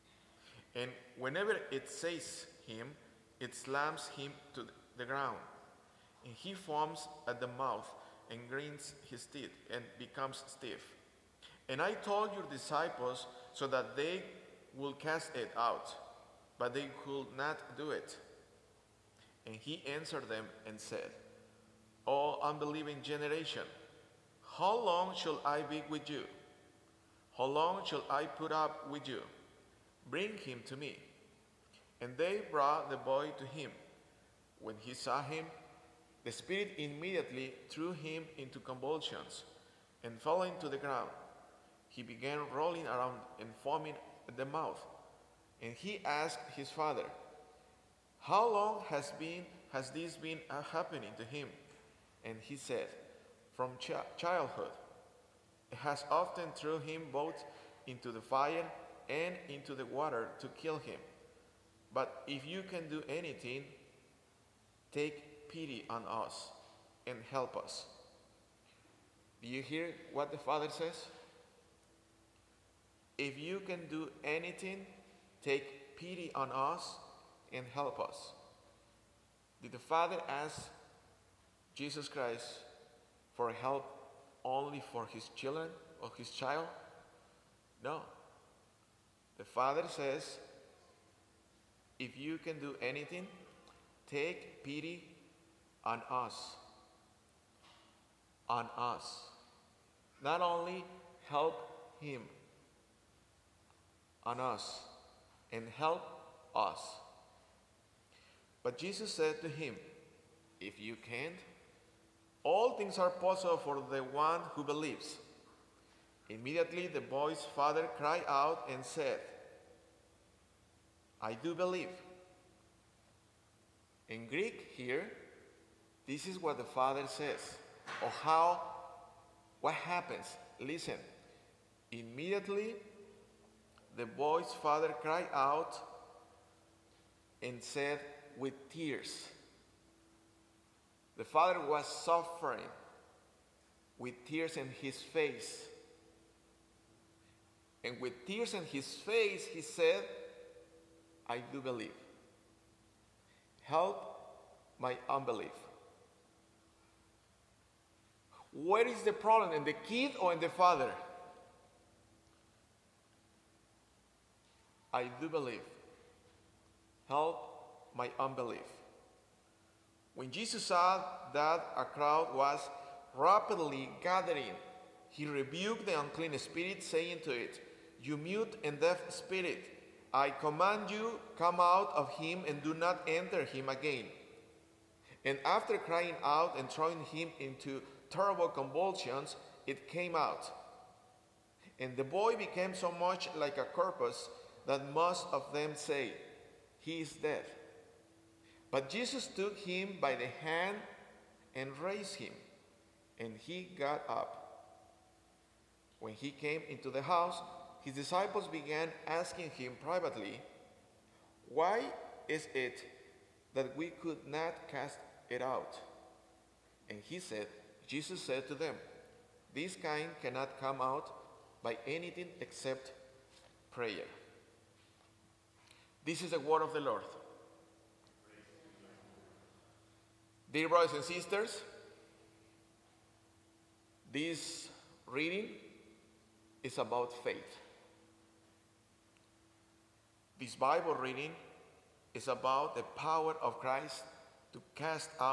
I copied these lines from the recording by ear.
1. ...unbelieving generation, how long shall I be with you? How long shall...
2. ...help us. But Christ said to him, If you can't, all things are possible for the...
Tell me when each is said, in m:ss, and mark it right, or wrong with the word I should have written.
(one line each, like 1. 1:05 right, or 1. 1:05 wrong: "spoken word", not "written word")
1. 0:22 right
2. 1:45 wrong: "Jesus", not "Christ".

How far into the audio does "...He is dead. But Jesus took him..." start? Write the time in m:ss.
3:16.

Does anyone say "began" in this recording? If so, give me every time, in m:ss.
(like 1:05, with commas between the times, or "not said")
0:42, 3:28.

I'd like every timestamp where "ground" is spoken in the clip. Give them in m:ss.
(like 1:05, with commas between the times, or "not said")
0:05, 0:40.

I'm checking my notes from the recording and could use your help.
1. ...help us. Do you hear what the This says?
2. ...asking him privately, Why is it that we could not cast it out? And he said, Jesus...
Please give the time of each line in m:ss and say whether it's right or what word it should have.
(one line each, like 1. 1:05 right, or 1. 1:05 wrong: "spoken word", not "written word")
1. 1:07 wrong: "Father", not "This"
2. 3:29 right.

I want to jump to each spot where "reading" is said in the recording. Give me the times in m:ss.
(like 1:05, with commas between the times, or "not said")
3:55, 4:00.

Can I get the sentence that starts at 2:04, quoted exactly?
In Greek, here, this is what the father says, or oh, how, what happens.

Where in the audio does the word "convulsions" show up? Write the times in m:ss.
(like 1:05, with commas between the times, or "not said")
0:38, 3:08.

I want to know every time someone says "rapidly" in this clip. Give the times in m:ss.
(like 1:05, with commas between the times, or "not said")
2:53.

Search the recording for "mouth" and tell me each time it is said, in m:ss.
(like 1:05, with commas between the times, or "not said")
0:07, 0:44.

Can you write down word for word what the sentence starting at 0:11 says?
And I told your disciples so that they would cast it out, but they could not do it.